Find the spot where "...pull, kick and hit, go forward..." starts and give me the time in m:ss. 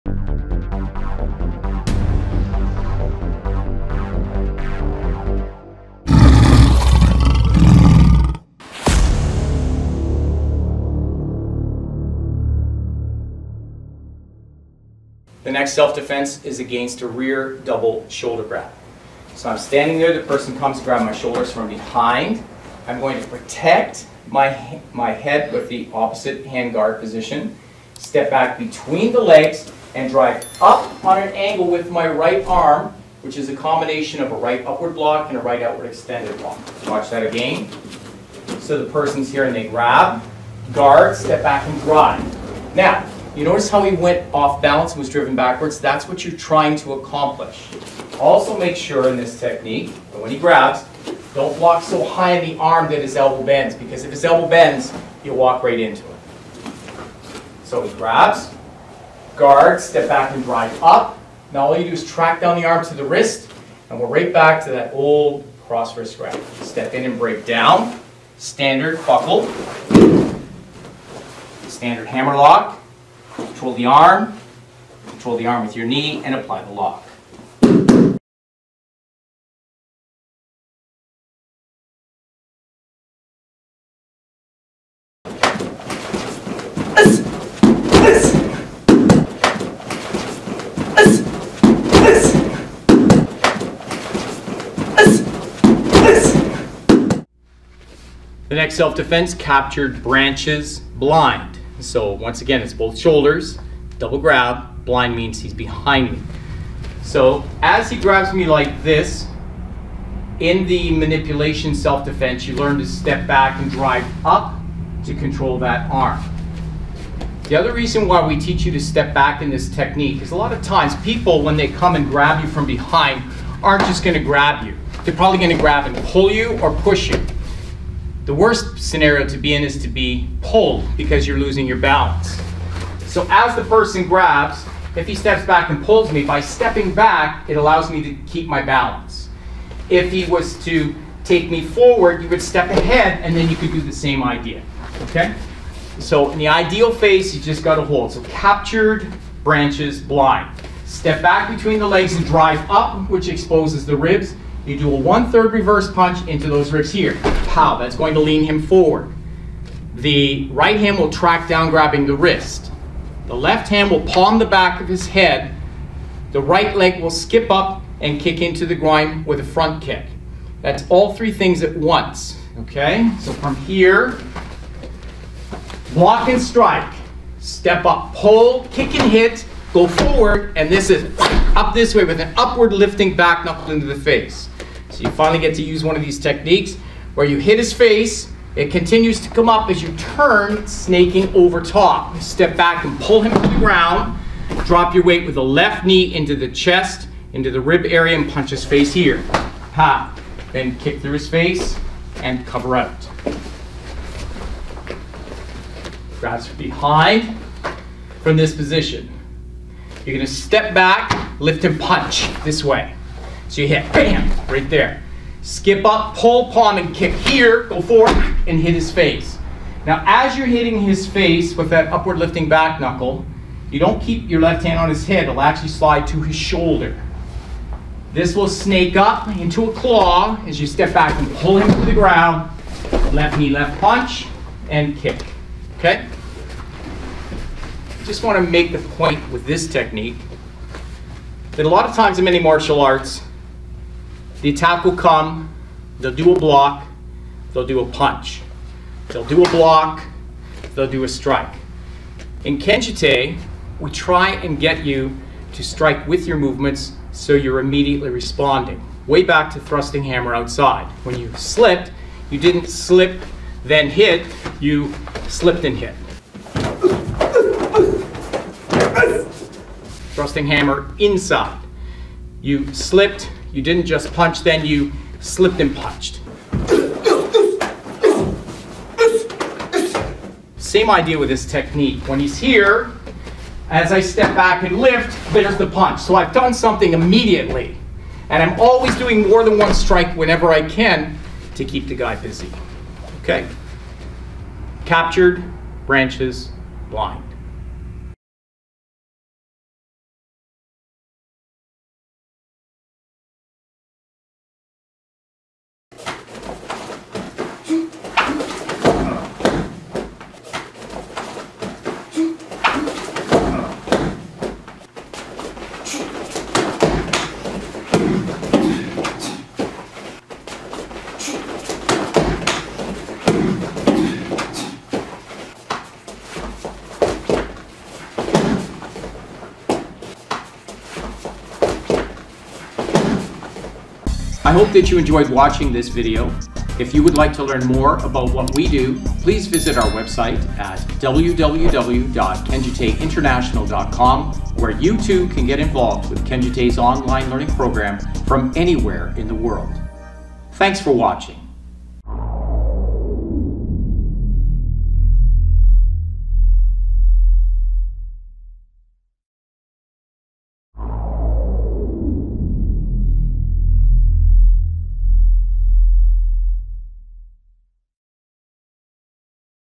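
2:58.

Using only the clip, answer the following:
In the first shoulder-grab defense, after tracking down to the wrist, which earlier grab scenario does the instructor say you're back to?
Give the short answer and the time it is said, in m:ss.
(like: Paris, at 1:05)
Cross wrist grab, at 1:05.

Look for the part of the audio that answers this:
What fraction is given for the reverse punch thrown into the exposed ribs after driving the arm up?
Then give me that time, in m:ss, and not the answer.
2:34.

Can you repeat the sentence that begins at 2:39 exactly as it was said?
The right hand will track down grabbing the wrist.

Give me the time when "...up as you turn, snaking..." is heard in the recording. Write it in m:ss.
3:09.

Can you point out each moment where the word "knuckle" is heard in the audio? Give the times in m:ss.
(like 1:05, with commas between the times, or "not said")
3:03, 3:42.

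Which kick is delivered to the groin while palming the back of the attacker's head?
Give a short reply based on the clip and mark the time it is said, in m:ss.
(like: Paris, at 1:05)
Front kick, at 2:49.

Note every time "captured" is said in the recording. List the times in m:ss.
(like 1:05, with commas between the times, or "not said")
1:39, 2:28, 4:54.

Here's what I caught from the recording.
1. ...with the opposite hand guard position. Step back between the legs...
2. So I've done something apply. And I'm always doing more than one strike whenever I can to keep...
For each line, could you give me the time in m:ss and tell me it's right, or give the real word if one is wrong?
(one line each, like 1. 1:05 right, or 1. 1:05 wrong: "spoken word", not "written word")
1. 0:25 right
2. 4:45 wrong: "immediately", not "apply".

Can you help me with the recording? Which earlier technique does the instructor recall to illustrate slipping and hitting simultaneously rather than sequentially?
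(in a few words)
Thrusting hammer outside.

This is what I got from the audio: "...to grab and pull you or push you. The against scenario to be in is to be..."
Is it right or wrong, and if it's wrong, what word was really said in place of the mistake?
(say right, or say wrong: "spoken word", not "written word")
wrong: "worst", not "against".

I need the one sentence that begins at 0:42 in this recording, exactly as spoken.
Now, you notice how he went off balance and was driven backwards?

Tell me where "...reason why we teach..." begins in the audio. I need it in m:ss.
1:57.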